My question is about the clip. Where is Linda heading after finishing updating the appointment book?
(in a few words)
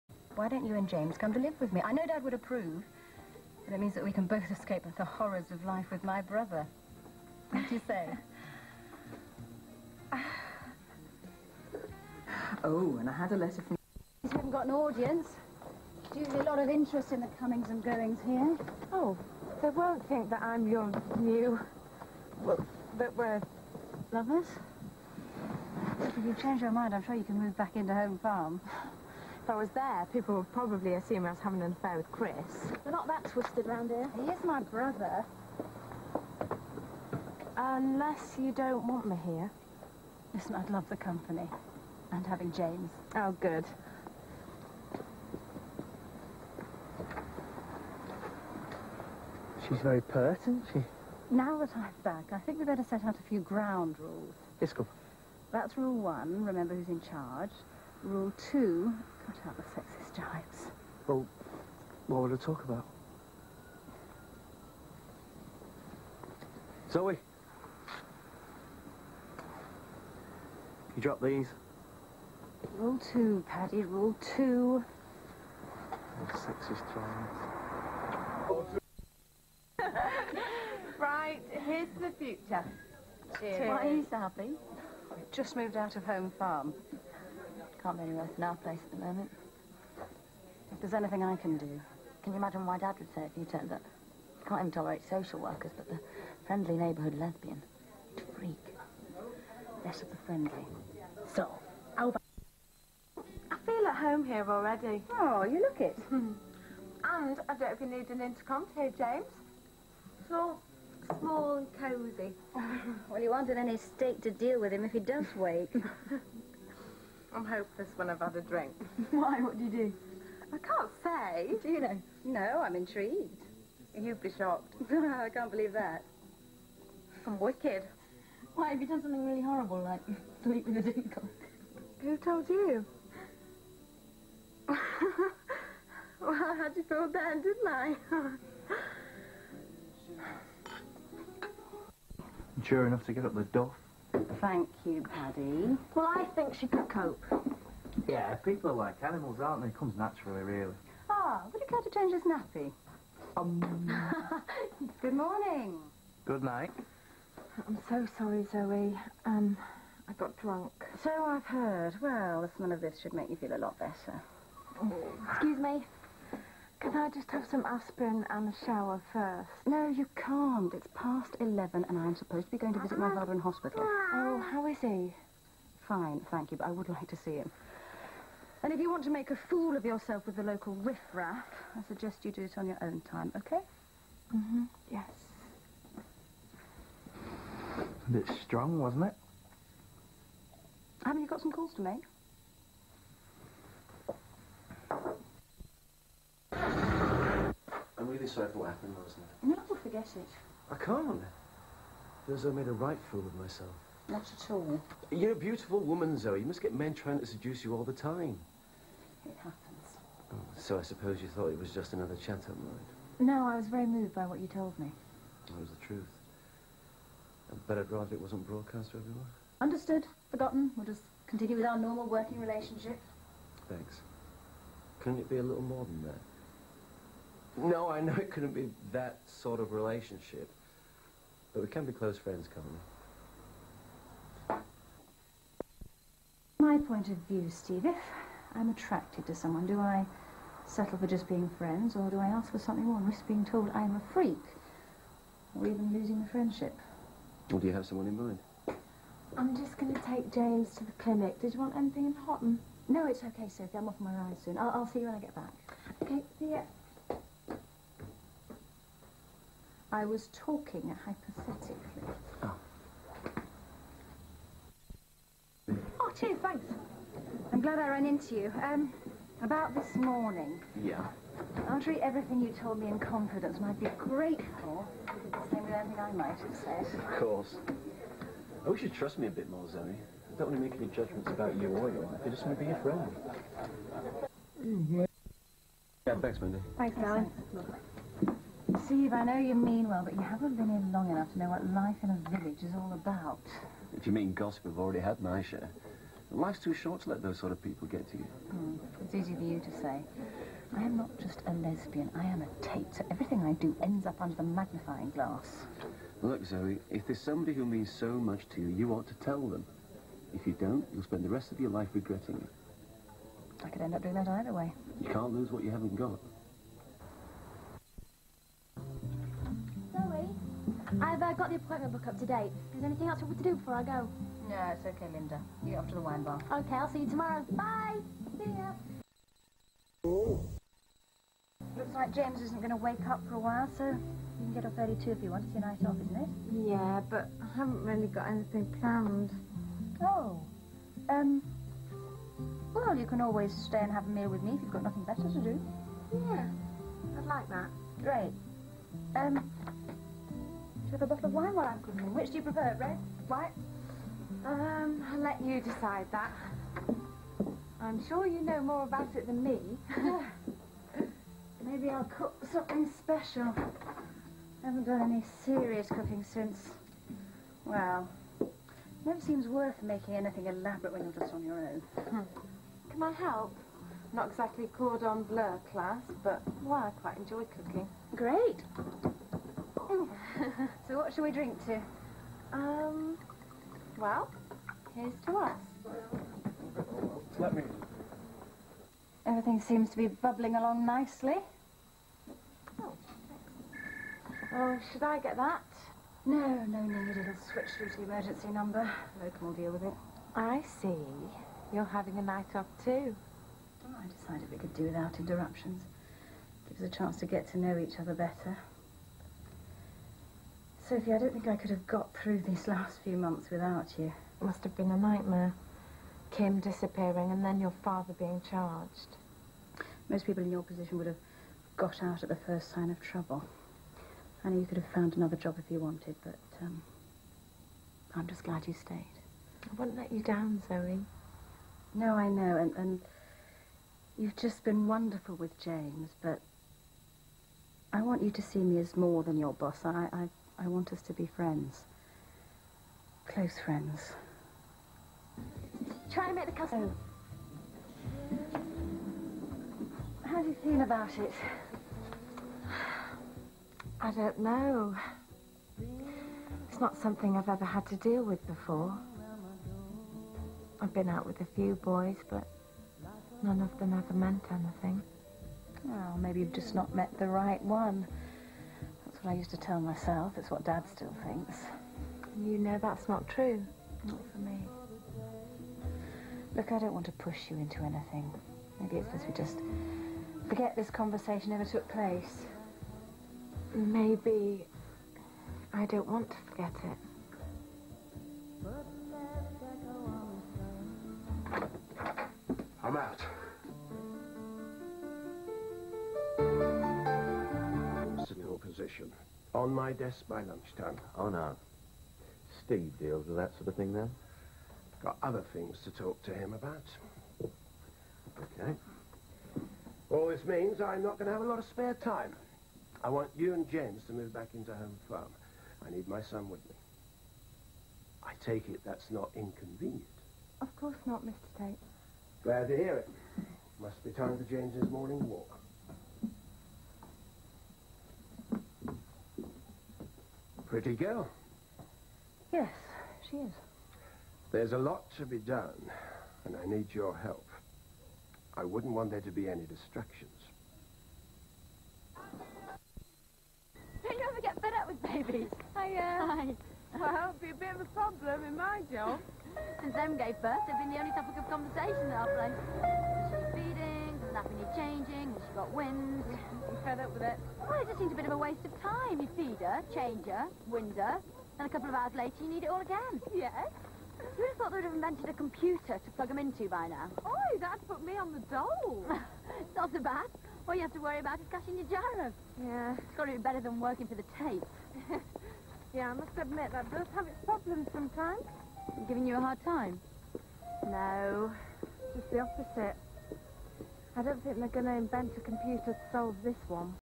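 The wine bar.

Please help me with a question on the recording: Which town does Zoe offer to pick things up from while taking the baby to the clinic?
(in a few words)
Hotton.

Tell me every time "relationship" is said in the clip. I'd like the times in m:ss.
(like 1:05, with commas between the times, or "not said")
3:42, 3:49.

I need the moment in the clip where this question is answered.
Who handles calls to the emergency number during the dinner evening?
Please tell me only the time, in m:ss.
6:39.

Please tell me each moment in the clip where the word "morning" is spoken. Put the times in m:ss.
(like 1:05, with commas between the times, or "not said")
2:35, 4:29, 8:44.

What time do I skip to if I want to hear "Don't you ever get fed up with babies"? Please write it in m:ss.
9:04.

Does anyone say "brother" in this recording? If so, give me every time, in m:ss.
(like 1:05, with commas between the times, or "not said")
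0:06, 0:34.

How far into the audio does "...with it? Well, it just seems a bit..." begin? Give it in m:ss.
9:17.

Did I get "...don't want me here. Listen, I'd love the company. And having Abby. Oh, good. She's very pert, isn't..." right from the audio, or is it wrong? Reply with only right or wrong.
wrong.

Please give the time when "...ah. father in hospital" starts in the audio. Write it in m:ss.
2:53.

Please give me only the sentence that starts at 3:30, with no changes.
Oh, so I suppose you thought it was just another chat-up night?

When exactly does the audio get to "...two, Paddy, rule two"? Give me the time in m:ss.
1:12.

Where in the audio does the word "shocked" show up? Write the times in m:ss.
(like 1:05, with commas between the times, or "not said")
2:04.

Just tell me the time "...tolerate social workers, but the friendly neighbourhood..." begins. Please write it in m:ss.
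1:34.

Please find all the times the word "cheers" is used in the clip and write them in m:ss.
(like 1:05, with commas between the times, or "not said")
1:23, 4:26.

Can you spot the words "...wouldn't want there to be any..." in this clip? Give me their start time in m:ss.
8:58.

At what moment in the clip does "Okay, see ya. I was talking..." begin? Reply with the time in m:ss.
4:16.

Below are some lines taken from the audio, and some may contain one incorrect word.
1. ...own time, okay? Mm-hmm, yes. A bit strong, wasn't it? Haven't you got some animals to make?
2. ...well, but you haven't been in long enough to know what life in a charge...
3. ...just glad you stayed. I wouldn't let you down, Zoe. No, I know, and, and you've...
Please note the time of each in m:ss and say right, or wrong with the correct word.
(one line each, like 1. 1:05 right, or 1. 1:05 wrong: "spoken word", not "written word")
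1. 3:02 wrong: "calls", not "animals"
2. 4:49 wrong: "village", not "charge"
3. 7:08 right.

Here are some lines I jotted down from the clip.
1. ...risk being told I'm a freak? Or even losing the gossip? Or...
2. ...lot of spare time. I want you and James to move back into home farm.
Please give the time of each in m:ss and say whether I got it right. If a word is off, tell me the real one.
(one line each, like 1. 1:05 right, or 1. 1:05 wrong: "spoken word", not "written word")
1. 4:03 wrong: "friendship", not "gossip"
2. 8:31 right.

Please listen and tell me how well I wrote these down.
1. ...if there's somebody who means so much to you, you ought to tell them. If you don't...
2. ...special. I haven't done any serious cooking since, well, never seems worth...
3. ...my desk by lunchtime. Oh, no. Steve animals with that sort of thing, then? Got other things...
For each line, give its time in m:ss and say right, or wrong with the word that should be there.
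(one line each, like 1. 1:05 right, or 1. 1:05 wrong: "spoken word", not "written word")
1. 5:06 right
2. 6:02 right
3. 8:19 wrong: "deals", not "animals".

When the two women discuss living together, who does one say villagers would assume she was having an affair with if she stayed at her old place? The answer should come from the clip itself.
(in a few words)
Chris.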